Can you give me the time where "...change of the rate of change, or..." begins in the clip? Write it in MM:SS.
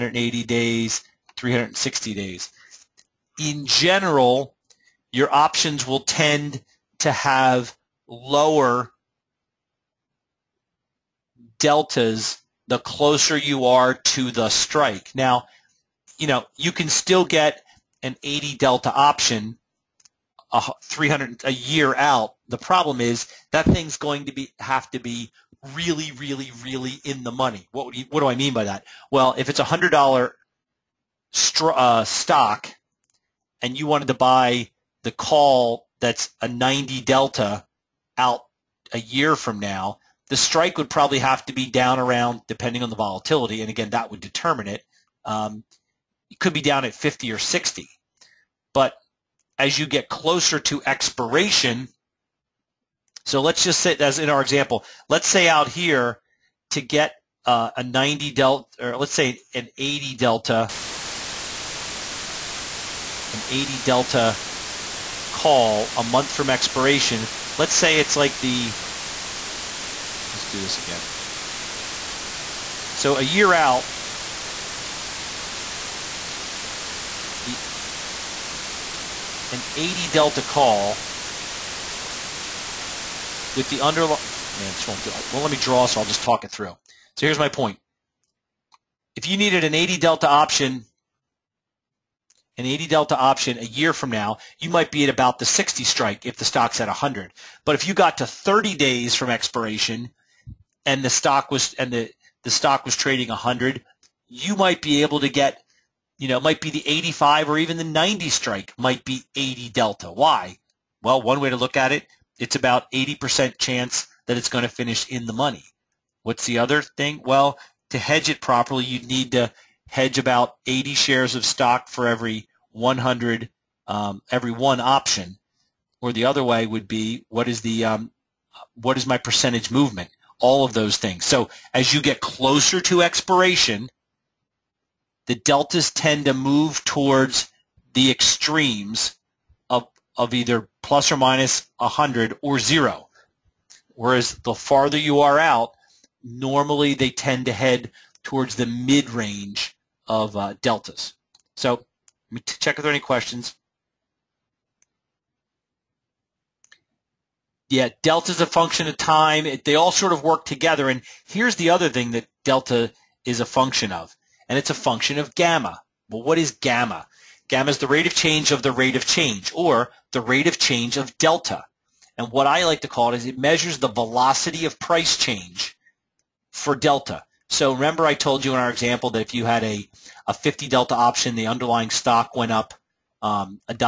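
02:48.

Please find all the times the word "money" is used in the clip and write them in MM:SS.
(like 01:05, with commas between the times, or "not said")
00:27, 01:55.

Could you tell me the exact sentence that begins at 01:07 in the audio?
Let's say it's like the, let's do this again.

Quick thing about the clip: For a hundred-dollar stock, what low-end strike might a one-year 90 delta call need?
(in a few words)
50.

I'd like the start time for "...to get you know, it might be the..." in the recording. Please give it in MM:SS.
01:45.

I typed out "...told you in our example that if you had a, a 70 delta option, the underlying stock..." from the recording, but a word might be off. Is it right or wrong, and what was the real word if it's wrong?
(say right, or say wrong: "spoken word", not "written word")
wrong: "50", not "70".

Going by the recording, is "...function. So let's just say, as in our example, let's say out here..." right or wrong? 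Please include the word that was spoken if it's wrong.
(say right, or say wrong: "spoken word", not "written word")
wrong: "expiration", not "function".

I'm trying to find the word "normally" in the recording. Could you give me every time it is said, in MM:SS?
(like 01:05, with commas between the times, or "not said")
02:26.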